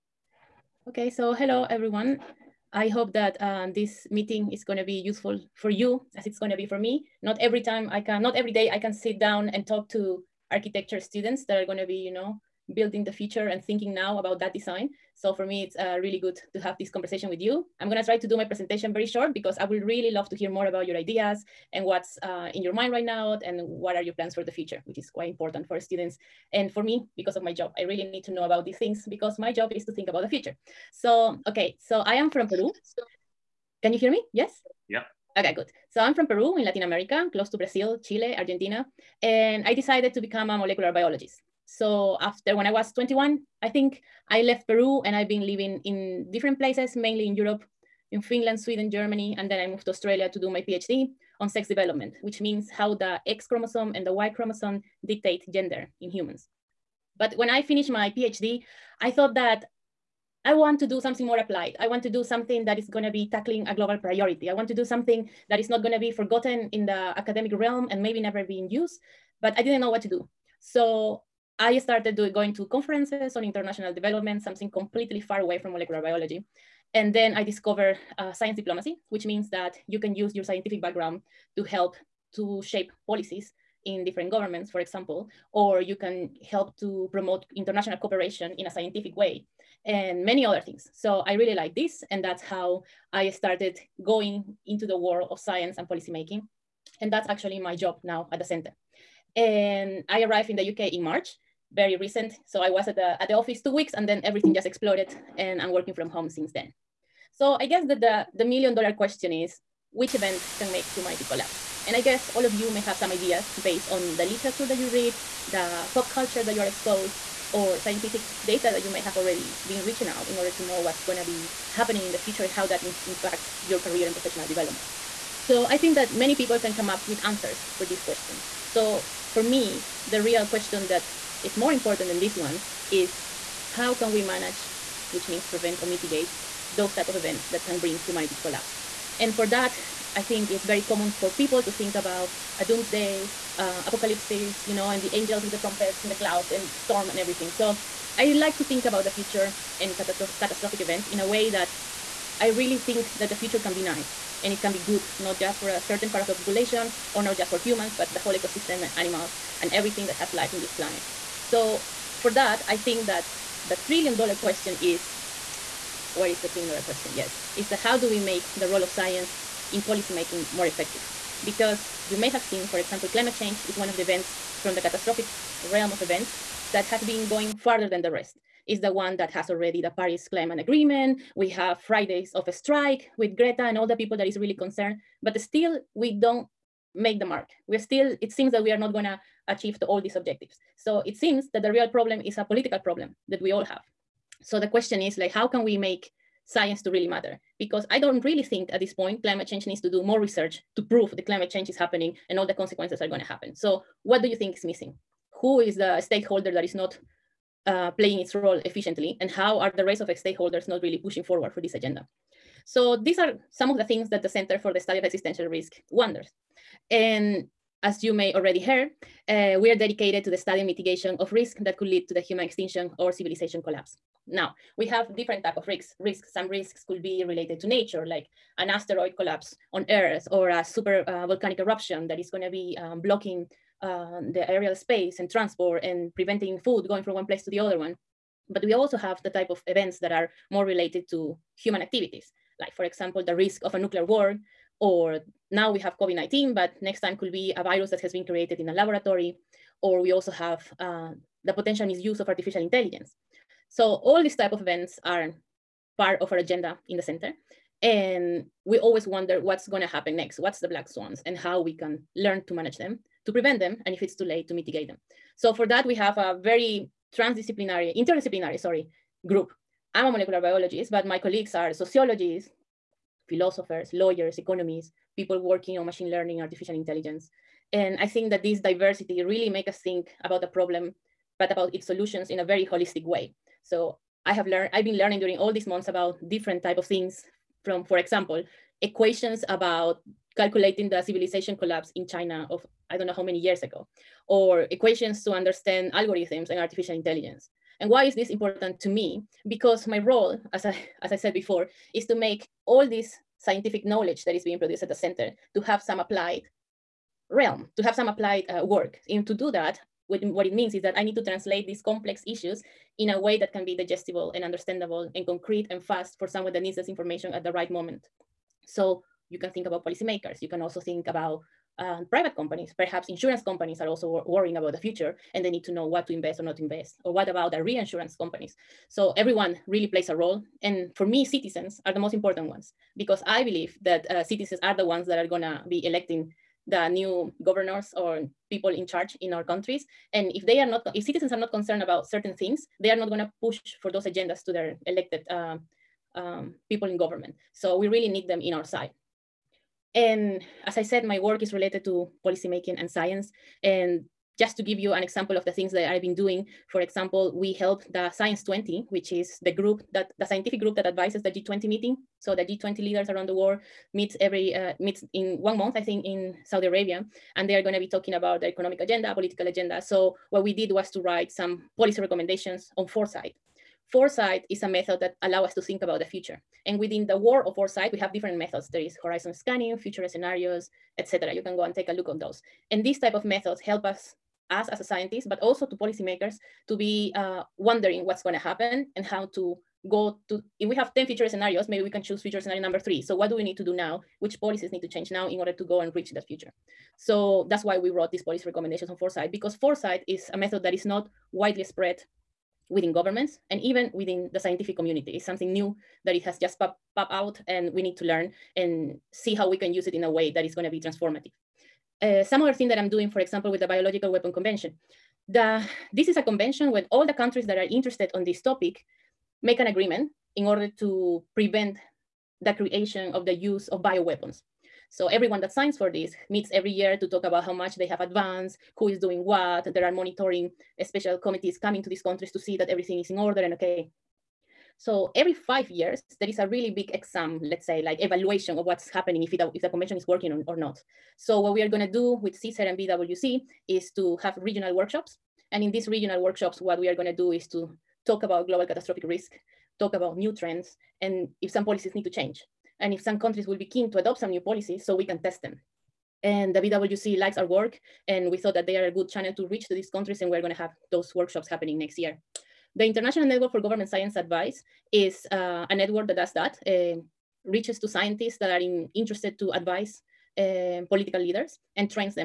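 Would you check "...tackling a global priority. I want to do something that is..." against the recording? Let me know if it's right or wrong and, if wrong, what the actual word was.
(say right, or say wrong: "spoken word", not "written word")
right.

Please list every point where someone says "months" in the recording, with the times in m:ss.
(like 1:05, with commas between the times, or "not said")
4:45, 6:05.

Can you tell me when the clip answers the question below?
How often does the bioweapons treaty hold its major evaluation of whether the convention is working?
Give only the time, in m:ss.
7:15.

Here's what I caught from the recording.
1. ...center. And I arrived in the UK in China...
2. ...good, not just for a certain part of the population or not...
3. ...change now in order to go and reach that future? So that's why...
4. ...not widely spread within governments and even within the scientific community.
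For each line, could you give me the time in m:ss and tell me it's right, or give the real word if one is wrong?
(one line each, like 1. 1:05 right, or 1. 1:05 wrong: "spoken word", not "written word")
1. 1:38 wrong: "March", not "China"
2. 2:34 right
3. 6:34 right
4. 6:40 right.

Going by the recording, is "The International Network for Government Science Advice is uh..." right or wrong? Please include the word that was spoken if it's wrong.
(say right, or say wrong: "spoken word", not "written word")
right.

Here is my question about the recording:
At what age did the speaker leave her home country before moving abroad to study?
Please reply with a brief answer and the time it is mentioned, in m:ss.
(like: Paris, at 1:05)
21, at 0:42.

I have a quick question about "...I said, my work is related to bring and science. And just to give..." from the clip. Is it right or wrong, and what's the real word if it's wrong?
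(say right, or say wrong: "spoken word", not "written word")
wrong: "policymaking", not "bring".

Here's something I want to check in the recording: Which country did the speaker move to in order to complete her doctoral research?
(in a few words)
Australia.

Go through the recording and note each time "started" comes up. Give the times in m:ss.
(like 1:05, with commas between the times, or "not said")
1:11, 1:33.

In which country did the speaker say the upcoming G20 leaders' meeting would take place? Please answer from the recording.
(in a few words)
Saudi Arabia.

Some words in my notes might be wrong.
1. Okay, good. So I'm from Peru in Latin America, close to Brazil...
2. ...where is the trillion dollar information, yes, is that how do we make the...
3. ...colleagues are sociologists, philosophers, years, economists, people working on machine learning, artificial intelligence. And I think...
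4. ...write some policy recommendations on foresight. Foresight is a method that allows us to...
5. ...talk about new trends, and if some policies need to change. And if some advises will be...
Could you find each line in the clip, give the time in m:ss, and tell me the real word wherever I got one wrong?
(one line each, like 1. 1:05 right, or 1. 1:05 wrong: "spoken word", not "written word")
1. 0:35 right
2. 2:46 wrong: "question", not "information"
3. 4:31 wrong: "lawyers", not "years"
4. 6:10 right
5. 7:29 wrong: "countries", not "advises".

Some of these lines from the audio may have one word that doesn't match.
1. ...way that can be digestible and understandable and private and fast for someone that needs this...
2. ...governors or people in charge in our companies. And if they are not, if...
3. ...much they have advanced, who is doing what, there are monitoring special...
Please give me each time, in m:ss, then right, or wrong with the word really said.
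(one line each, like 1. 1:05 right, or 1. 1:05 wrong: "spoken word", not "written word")
1. 5:13 wrong: "concrete", not "private"
2. 5:37 wrong: "countries", not "companies"
3. 7:07 right.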